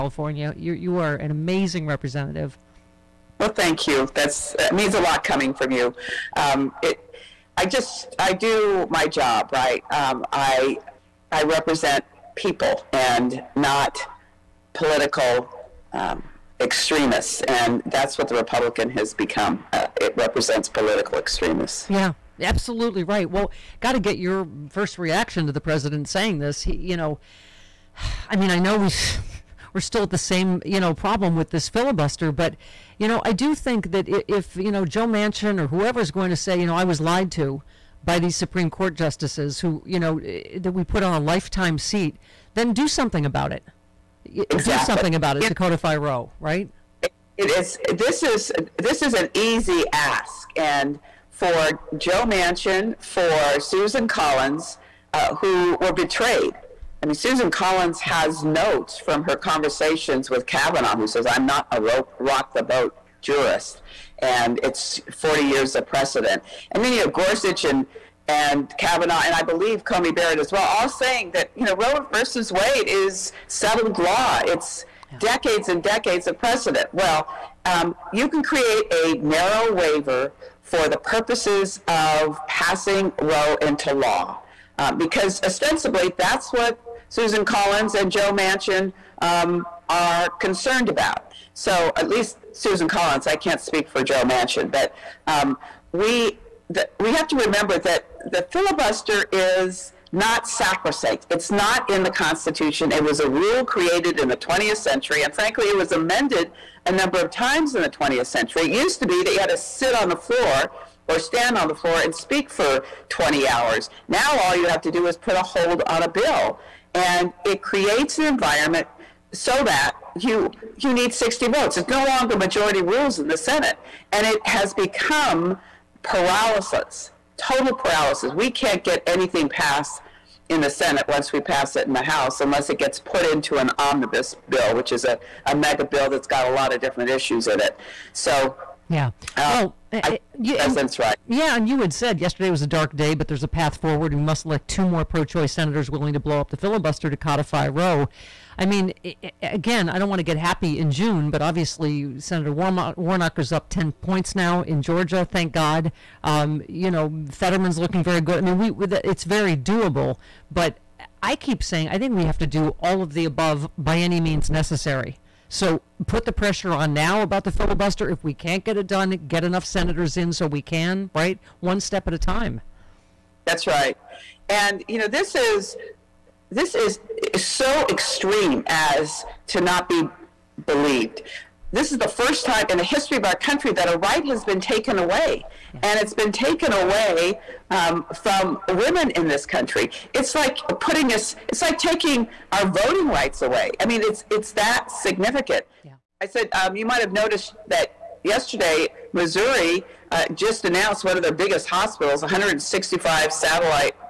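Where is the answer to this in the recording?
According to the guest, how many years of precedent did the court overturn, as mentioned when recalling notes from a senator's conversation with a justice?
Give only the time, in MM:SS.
01:05.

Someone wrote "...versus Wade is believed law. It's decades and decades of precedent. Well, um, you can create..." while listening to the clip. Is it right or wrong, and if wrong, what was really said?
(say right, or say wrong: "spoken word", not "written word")
wrong: "settled", not "believed".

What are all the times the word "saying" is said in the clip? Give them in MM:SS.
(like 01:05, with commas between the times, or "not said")
00:26, 01:10, 02:41.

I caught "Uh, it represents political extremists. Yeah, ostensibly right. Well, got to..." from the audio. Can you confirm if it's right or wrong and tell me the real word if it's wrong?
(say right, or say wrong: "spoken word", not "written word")
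wrong: "absolutely", not "ostensibly".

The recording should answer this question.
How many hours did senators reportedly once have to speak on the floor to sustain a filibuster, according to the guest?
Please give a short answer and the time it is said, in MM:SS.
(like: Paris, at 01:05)
20 hours, at 01:53.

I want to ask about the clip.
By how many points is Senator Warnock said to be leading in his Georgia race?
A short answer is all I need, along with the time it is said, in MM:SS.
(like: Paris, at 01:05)
10 points, at 02:33.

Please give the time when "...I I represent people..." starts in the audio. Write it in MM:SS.
00:10.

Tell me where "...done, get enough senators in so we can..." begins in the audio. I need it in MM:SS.
02:48.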